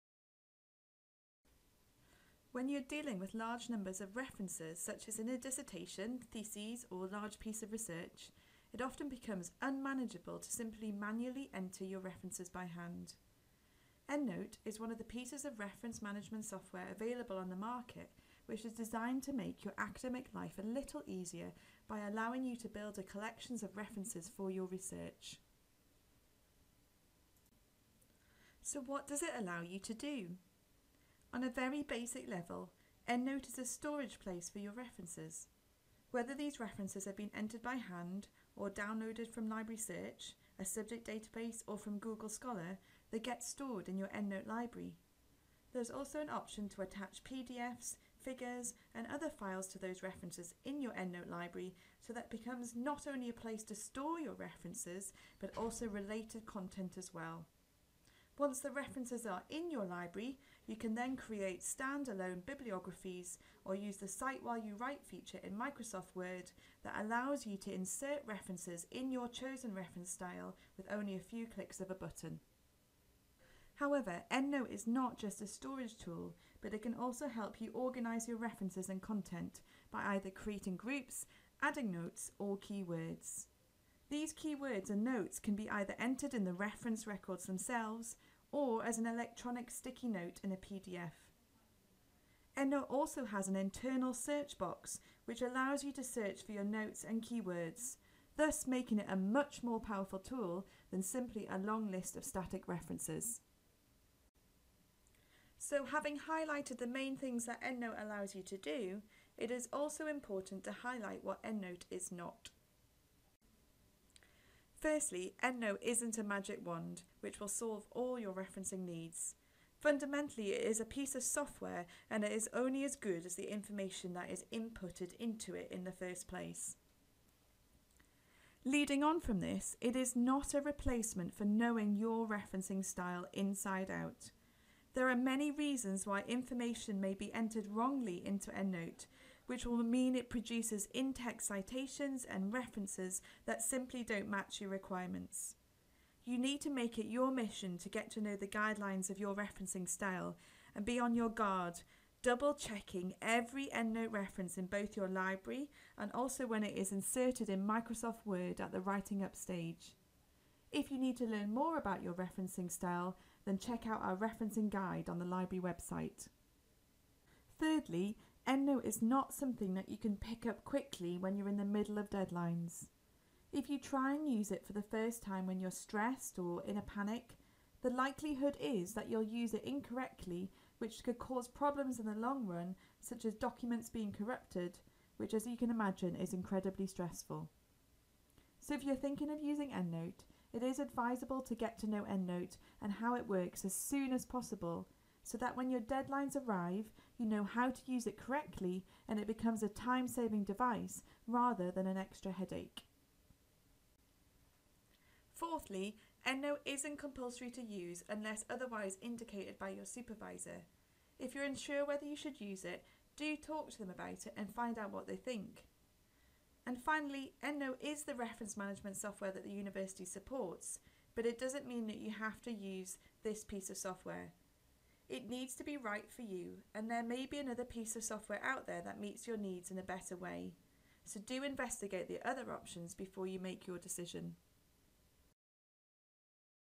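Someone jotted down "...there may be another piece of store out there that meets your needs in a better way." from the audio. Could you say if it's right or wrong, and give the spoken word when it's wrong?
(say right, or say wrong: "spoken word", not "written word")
wrong: "software", not "store".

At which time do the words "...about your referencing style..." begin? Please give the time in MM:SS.
02:41.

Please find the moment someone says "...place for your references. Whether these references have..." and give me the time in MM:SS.
00:34.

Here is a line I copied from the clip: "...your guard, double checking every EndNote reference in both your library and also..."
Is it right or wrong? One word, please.
right.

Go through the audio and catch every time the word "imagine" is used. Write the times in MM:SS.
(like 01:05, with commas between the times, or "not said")
03:05.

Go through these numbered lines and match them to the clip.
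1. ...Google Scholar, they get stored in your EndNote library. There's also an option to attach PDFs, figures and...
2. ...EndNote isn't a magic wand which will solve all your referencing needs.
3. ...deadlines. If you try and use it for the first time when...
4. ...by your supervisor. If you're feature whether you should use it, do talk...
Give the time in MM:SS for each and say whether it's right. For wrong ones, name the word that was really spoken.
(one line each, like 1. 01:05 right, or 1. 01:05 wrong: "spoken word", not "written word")
1. 00:41 right
2. 01:55 right
3. 02:52 right
4. 03:29 wrong: "unsure", not "feature".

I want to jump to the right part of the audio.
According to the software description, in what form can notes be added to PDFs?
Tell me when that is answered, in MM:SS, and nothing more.
01:29.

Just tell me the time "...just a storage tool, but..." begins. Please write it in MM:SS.
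01:15.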